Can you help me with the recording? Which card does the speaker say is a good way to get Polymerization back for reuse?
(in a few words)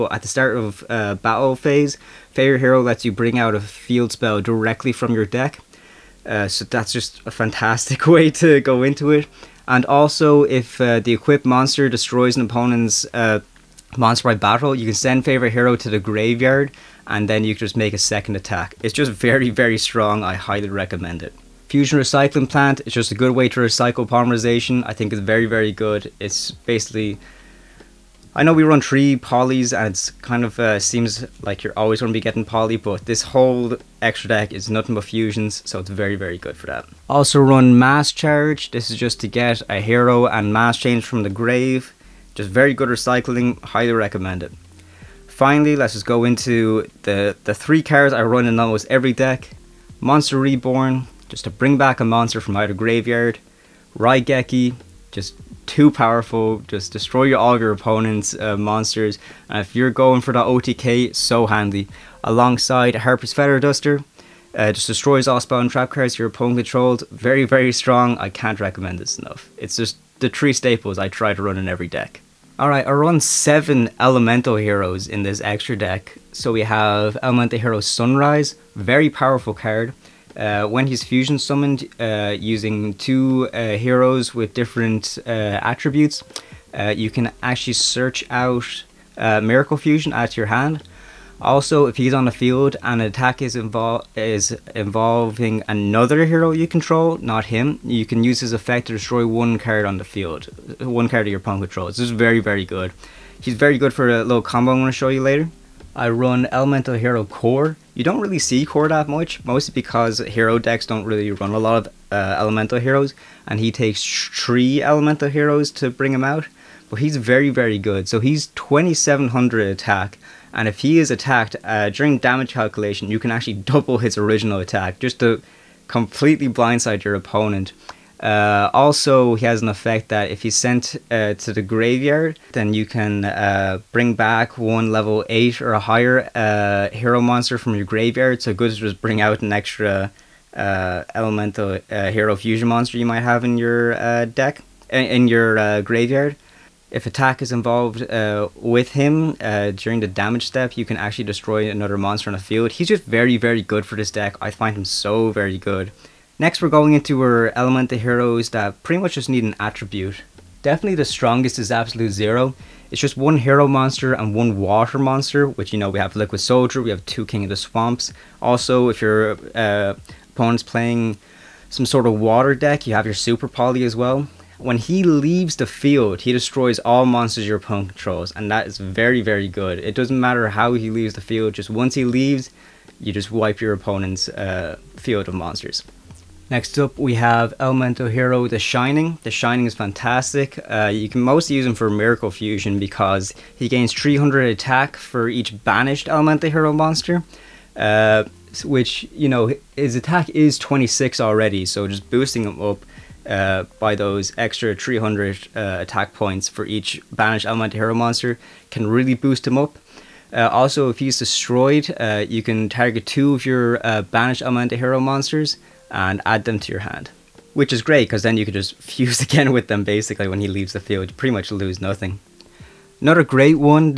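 Fusion Recycling Plant.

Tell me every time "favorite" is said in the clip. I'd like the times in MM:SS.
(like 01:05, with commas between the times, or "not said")
00:02, 00:15.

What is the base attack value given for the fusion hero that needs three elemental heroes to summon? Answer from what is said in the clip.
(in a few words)
2700.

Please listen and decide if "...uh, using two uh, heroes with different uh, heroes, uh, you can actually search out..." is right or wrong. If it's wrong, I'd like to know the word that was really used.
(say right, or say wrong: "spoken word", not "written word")
wrong: "attributes", not "heroes".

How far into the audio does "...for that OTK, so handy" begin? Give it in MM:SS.
01:00.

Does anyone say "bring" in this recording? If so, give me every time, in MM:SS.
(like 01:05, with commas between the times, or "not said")
00:03, 00:51, 01:55, 02:13, 02:19.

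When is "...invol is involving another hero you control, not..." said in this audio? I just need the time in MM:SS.
01:33.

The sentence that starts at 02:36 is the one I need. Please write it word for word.
Next, we're going into our elemental heroes that pretty much just need an attribute.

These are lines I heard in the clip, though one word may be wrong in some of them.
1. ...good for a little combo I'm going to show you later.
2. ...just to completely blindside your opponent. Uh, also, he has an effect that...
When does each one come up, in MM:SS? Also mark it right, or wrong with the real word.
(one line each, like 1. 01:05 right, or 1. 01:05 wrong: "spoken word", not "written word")
1. 01:43 right
2. 02:04 right.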